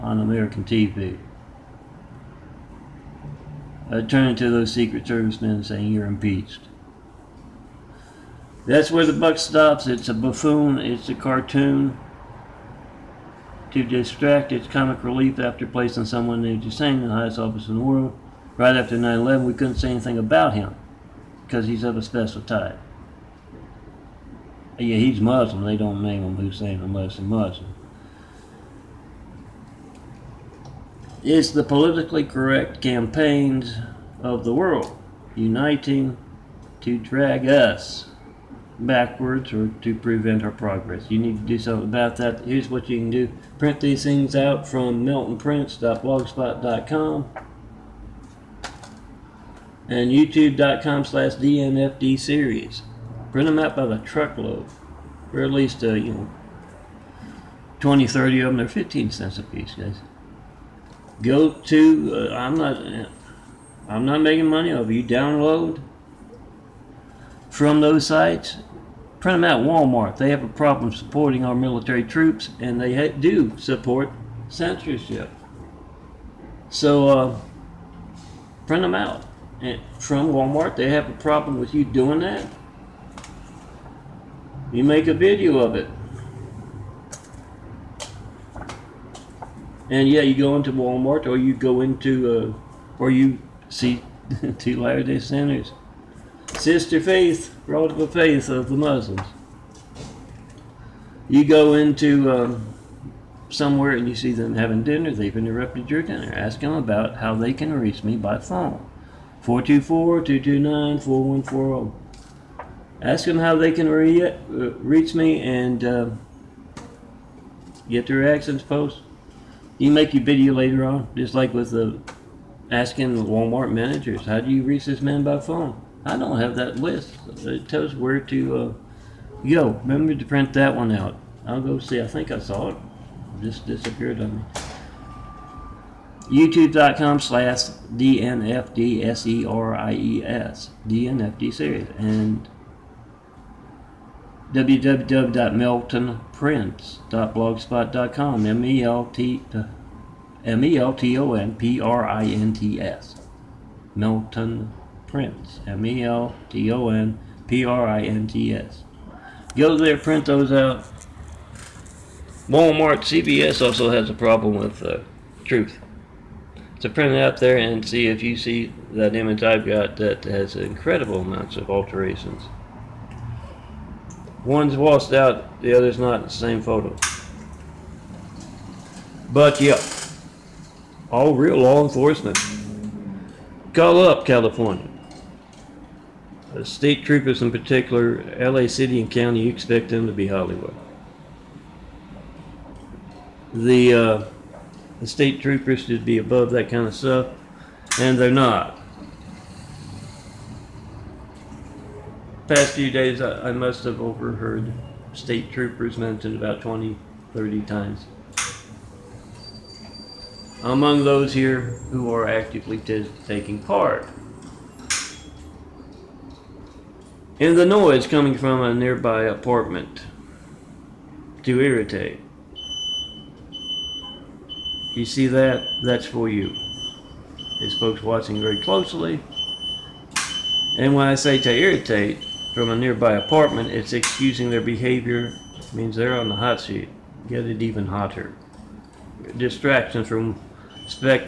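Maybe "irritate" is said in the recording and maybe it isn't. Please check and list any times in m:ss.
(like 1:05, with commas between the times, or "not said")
3:41, 3:51.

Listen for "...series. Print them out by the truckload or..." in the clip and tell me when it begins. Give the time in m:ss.
0:52.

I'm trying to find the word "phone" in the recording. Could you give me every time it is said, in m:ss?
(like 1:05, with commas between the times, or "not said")
1:48, 2:05.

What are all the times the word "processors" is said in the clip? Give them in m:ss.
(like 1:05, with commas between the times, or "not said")
not said.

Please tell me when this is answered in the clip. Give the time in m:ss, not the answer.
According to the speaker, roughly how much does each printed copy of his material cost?
0:58.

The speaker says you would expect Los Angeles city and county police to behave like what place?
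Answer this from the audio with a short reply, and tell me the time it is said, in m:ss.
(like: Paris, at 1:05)
Hollywood, at 3:10.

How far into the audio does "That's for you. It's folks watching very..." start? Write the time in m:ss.
3:45.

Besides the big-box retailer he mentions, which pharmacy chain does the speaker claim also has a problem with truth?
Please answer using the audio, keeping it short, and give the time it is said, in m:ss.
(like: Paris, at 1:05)
CVS, at 2:43.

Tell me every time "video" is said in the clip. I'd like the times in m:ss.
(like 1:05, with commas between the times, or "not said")
1:25, 2:00.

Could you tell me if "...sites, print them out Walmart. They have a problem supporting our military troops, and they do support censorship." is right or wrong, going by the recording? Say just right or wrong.
right.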